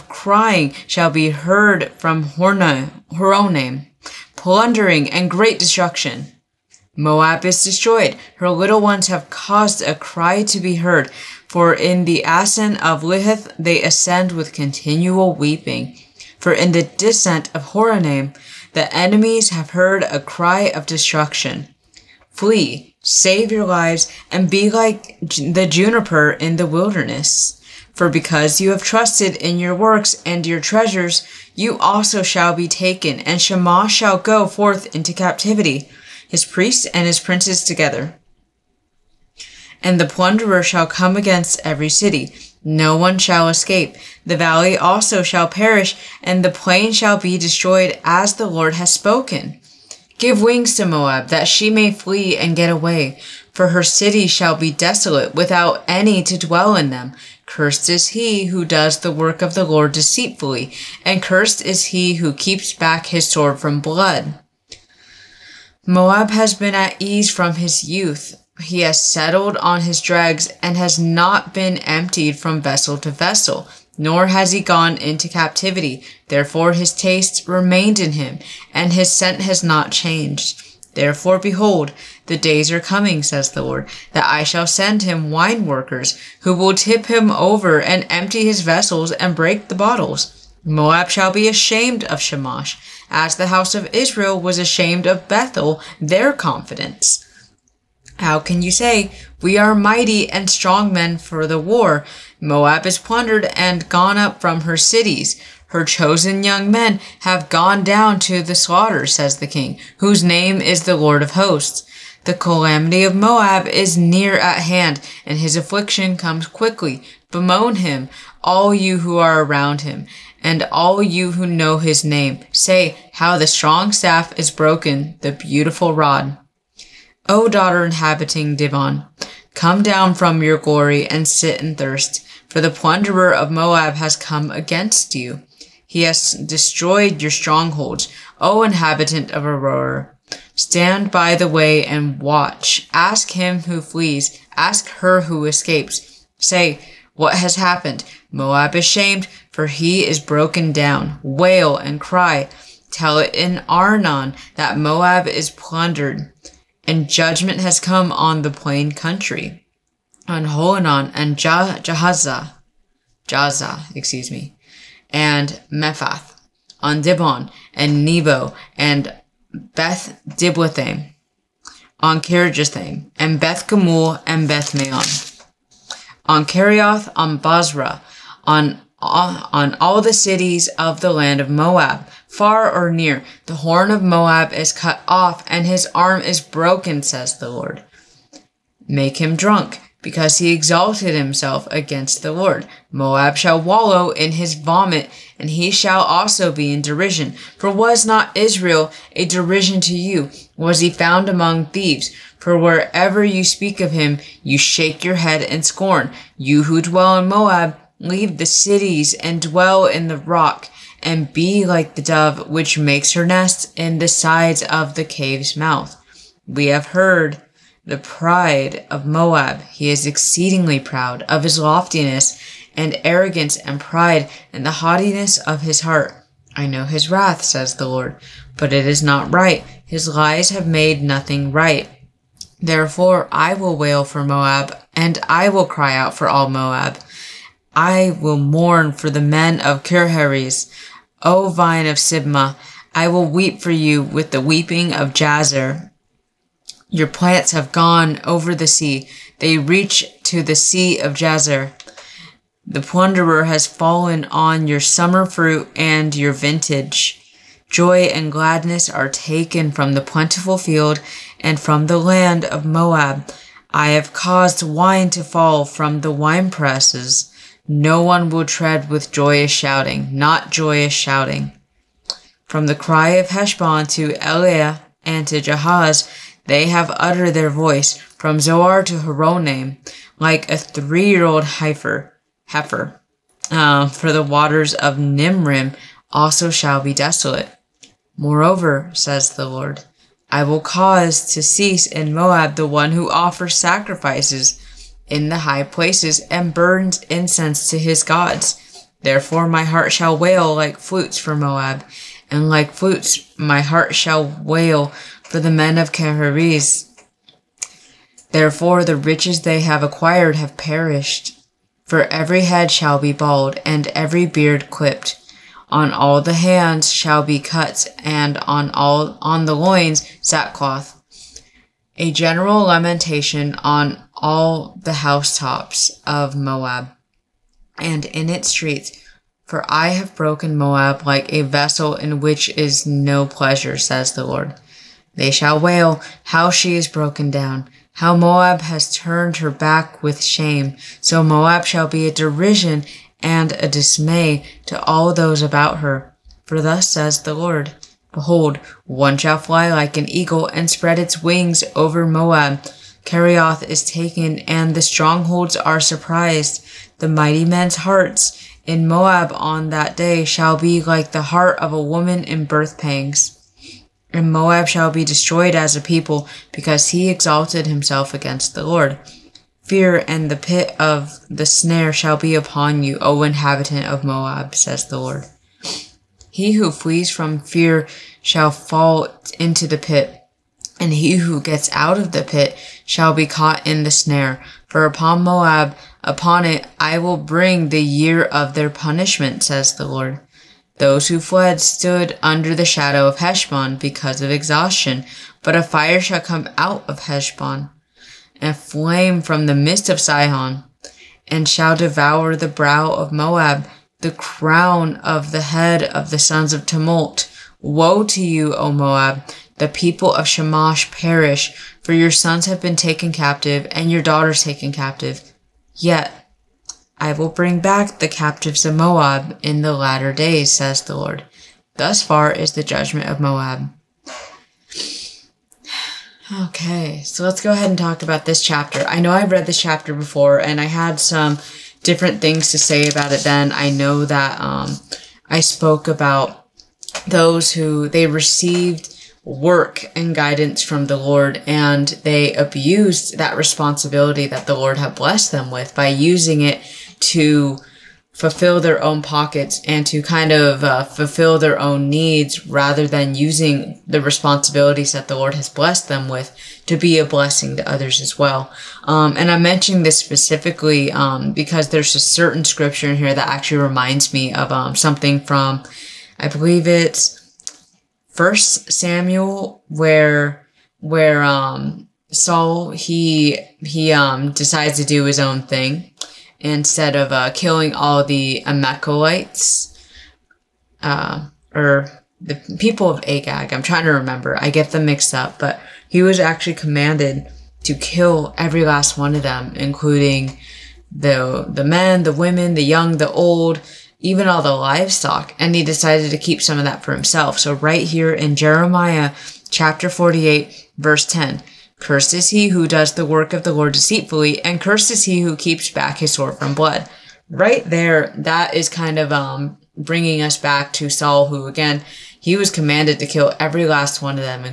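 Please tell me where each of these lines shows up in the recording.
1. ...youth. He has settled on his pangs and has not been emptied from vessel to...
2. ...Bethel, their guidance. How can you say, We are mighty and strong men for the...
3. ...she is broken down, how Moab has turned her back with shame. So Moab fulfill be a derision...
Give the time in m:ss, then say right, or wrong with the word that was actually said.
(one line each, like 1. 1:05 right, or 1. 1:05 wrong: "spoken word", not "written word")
1. 1:07 wrong: "dregs", not "pangs"
2. 1:35 wrong: "confidence", not "guidance"
3. 5:36 wrong: "shall", not "fulfill".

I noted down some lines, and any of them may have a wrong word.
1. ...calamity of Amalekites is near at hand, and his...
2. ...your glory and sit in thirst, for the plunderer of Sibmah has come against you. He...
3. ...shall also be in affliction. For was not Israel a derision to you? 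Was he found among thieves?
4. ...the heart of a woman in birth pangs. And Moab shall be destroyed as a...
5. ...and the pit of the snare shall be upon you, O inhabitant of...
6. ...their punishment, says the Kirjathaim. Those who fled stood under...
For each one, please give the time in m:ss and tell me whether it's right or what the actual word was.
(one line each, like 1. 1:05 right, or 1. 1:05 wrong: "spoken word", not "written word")
1. 1:52 wrong: "Moab", not "Amalekites"
2. 2:10 wrong: "Moab", not "Sibmah"
3. 3:15 wrong: "derision", not "affliction"
4. 6:01 right
5. 6:10 right
6. 6:28 wrong: "Lord", not "Kirjathaim".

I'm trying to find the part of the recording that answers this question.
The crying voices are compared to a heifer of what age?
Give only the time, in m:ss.
4:40.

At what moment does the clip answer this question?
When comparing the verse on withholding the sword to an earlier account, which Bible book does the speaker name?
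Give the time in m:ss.
7:48.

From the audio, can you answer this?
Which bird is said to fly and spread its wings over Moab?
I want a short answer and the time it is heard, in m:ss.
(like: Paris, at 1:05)
an eagle, at 5:50.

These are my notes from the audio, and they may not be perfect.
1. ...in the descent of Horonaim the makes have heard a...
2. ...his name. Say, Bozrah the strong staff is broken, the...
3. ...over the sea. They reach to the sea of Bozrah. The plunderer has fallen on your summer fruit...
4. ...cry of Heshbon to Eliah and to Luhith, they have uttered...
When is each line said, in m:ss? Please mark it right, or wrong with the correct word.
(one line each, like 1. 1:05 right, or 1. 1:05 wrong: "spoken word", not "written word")
1. 0:16 wrong: "enemies", not "makes"
2. 2:01 wrong: "How", not "Bozrah"
3. 4:08 wrong: "Jazer", not "Bozrah"
4. 4:32 wrong: "Jahaz", not "Luhith".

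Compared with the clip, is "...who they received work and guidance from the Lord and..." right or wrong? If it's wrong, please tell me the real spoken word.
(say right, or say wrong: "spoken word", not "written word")
right.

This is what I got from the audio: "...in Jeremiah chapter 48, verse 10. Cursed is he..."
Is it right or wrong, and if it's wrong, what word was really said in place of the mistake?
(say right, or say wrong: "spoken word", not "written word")
right.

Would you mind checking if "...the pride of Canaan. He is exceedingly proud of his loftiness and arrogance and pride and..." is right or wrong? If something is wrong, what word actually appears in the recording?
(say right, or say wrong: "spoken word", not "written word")
wrong: "Moab", not "Canaan".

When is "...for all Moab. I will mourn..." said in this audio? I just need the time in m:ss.
3:56.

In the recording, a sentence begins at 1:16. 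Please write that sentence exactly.
Therefore his taste remained in him, and his scent has not changed.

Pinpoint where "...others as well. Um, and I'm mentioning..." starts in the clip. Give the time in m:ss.
7:37.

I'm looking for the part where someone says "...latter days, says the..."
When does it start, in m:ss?
6:59.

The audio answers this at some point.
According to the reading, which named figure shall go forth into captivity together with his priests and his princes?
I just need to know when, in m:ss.
0:33.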